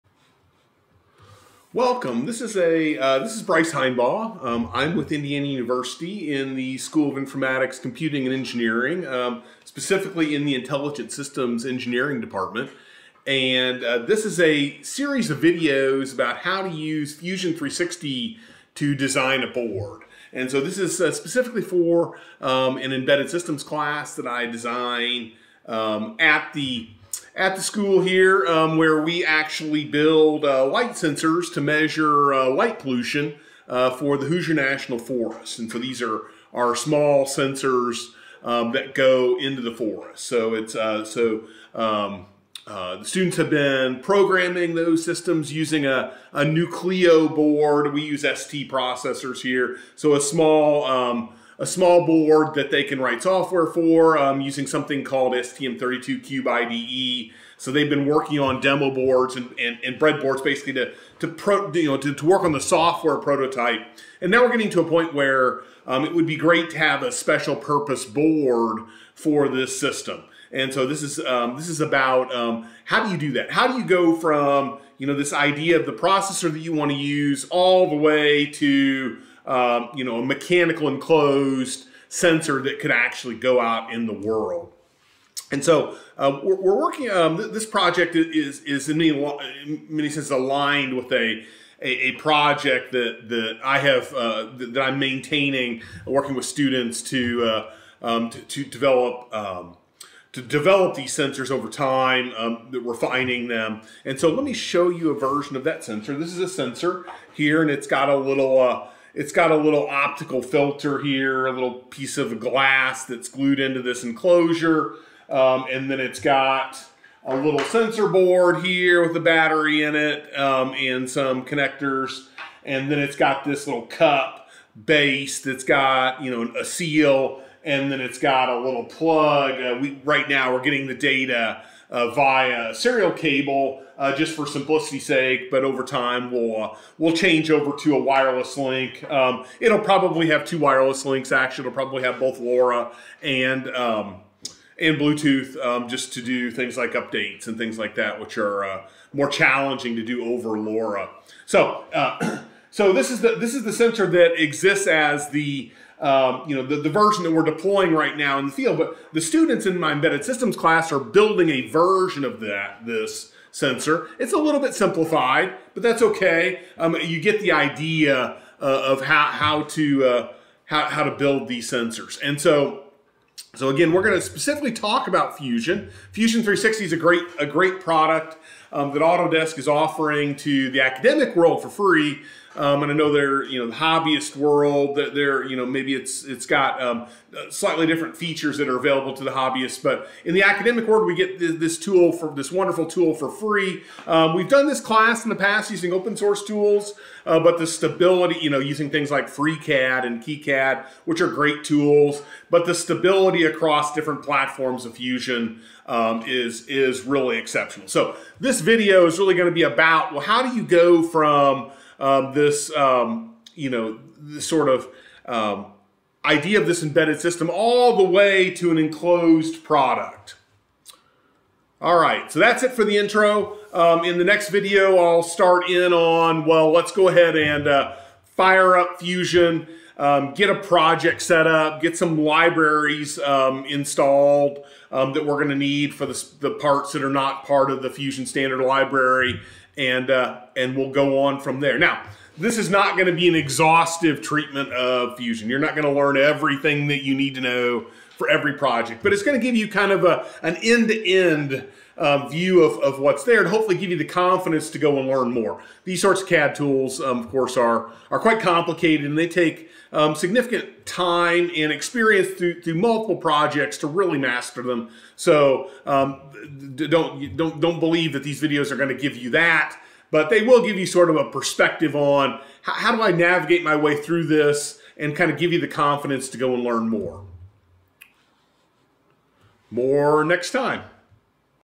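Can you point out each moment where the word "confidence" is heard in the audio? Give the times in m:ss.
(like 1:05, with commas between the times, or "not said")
4:14, 4:35.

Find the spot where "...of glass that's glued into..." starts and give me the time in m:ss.
1:52.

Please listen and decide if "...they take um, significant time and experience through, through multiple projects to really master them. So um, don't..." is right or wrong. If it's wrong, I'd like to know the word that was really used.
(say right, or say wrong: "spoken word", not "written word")
right.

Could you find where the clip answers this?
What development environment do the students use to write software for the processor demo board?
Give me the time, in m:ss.
0:55.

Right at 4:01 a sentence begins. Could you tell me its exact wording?
Now, this is not going to be an exhaustive treatment of Fusion.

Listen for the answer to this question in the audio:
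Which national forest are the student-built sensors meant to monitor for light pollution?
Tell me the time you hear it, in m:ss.
0:34.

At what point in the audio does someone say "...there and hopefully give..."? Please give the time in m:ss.
4:13.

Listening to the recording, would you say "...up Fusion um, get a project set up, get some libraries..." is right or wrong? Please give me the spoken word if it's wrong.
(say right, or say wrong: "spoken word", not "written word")
right.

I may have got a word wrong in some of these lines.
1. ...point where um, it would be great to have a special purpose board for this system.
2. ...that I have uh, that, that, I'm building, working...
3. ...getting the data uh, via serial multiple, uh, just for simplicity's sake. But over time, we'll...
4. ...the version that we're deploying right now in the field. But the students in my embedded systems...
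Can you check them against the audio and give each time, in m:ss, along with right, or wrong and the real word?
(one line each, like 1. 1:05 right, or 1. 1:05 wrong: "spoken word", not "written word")
1. 1:04 right
2. 1:33 wrong: "maintaining", not "building"
3. 2:10 wrong: "cable", not "multiple"
4. 2:36 right.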